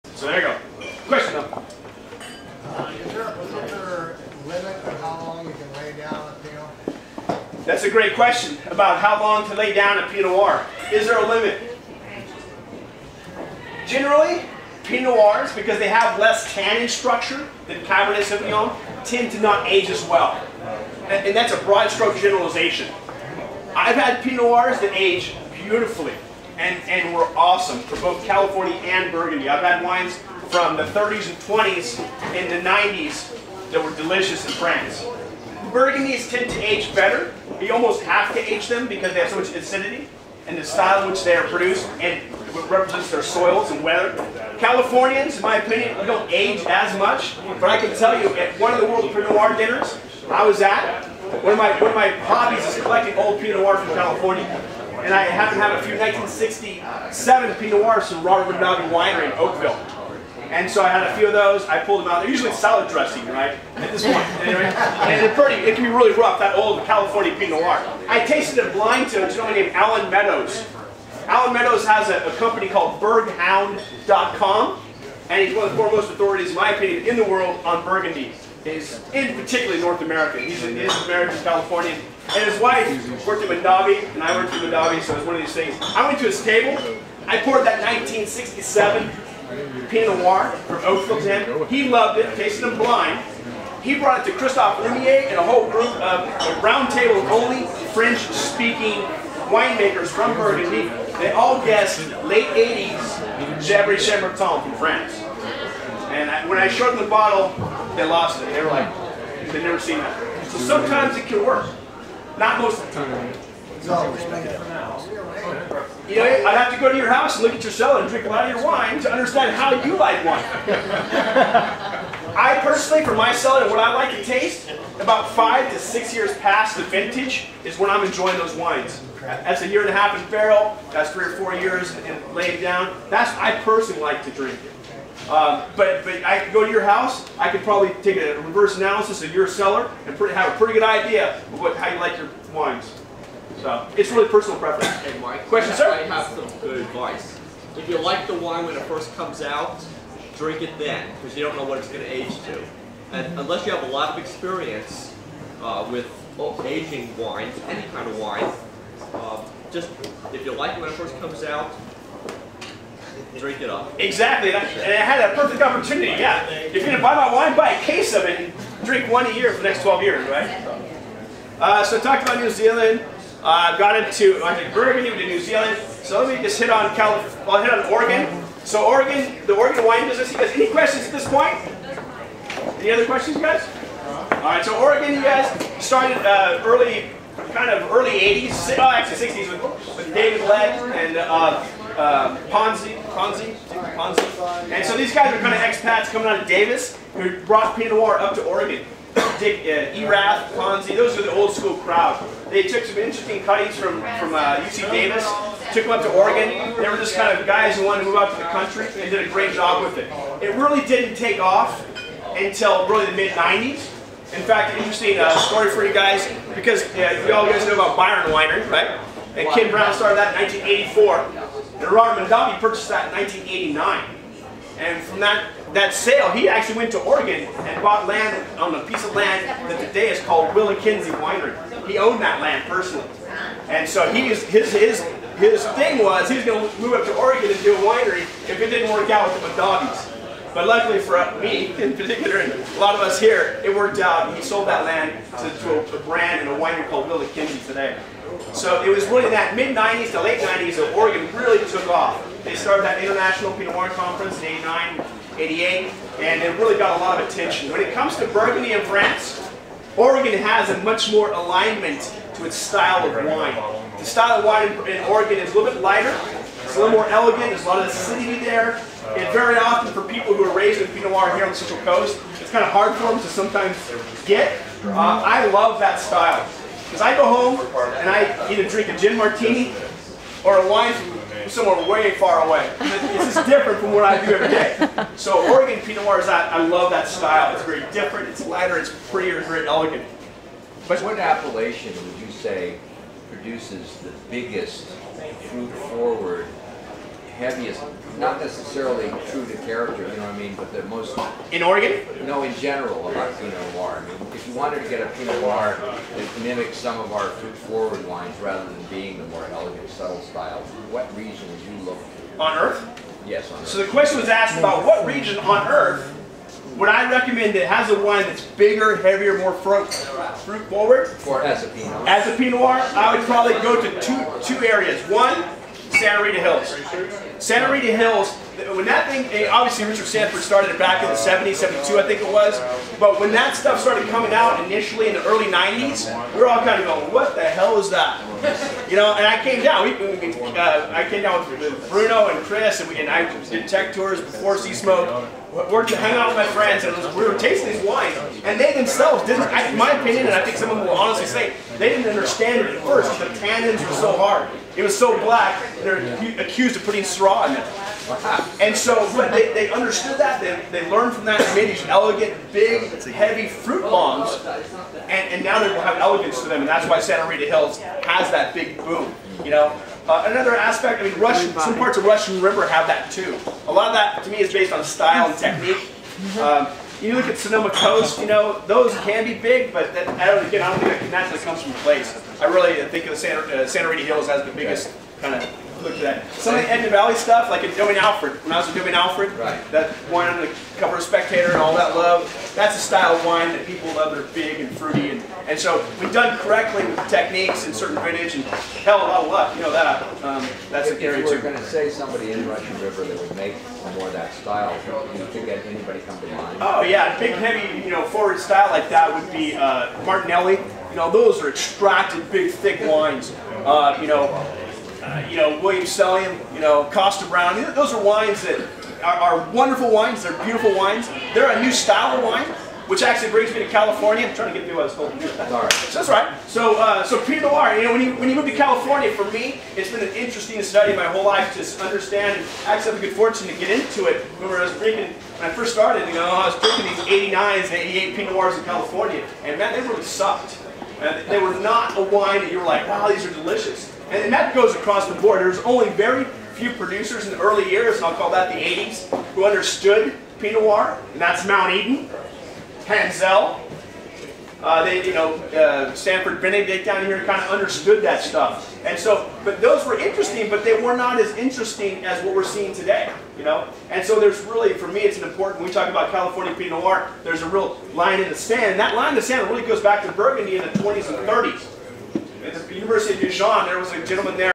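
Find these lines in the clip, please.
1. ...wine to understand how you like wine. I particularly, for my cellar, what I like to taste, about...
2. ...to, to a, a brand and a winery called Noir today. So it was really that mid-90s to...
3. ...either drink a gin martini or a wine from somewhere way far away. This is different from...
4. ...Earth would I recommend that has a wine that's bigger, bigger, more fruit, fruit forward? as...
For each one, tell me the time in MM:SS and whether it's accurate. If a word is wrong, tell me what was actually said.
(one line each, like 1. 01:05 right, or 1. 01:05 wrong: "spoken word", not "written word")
1. 01:58 wrong: "personally", not "particularly"
2. 04:05 wrong: "WillaKenzie", not "Noir"
3. 04:38 right
4. 05:15 wrong: "heavier", not "bigger".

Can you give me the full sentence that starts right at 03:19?
Dick uh, Erath, Ponzi, those are the old school crowd.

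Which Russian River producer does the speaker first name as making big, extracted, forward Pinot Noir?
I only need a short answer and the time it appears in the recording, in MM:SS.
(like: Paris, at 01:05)
Martinelli, at 06:50.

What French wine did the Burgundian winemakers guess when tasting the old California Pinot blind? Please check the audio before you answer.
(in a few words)
Chablis Chambertin.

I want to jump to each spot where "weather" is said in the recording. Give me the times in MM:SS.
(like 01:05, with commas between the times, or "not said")
00:43.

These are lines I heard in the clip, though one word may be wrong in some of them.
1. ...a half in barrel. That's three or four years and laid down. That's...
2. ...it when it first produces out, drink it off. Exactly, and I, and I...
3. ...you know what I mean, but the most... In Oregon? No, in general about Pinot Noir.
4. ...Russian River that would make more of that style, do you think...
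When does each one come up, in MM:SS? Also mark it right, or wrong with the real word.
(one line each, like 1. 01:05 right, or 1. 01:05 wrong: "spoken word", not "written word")
1. 02:09 right
2. 02:40 wrong: "comes", not "produces"
3. 05:00 right
4. 06:42 right.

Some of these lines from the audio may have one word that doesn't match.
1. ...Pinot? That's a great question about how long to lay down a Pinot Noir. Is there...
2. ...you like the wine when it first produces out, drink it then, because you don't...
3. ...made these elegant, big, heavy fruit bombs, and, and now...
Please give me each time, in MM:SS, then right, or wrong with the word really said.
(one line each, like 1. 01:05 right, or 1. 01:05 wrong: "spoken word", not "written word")
1. 00:06 right
2. 02:27 wrong: "comes", not "produces"
3. 06:01 right.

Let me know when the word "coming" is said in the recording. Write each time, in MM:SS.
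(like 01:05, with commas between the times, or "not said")
03:16, 05:34.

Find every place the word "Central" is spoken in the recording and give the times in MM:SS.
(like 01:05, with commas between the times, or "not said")
04:31.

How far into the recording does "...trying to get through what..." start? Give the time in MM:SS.
07:04.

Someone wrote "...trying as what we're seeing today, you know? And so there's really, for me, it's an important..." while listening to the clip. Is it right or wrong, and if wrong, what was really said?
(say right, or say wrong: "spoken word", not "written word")
wrong: "interesting", not "trying".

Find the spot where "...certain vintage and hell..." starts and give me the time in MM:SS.
06:37.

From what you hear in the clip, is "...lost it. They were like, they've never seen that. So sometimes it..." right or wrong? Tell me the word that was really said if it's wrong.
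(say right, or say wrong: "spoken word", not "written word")
right.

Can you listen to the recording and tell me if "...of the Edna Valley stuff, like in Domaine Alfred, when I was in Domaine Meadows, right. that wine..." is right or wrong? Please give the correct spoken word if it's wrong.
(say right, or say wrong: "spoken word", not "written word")
wrong: "Alfred", not "Meadows".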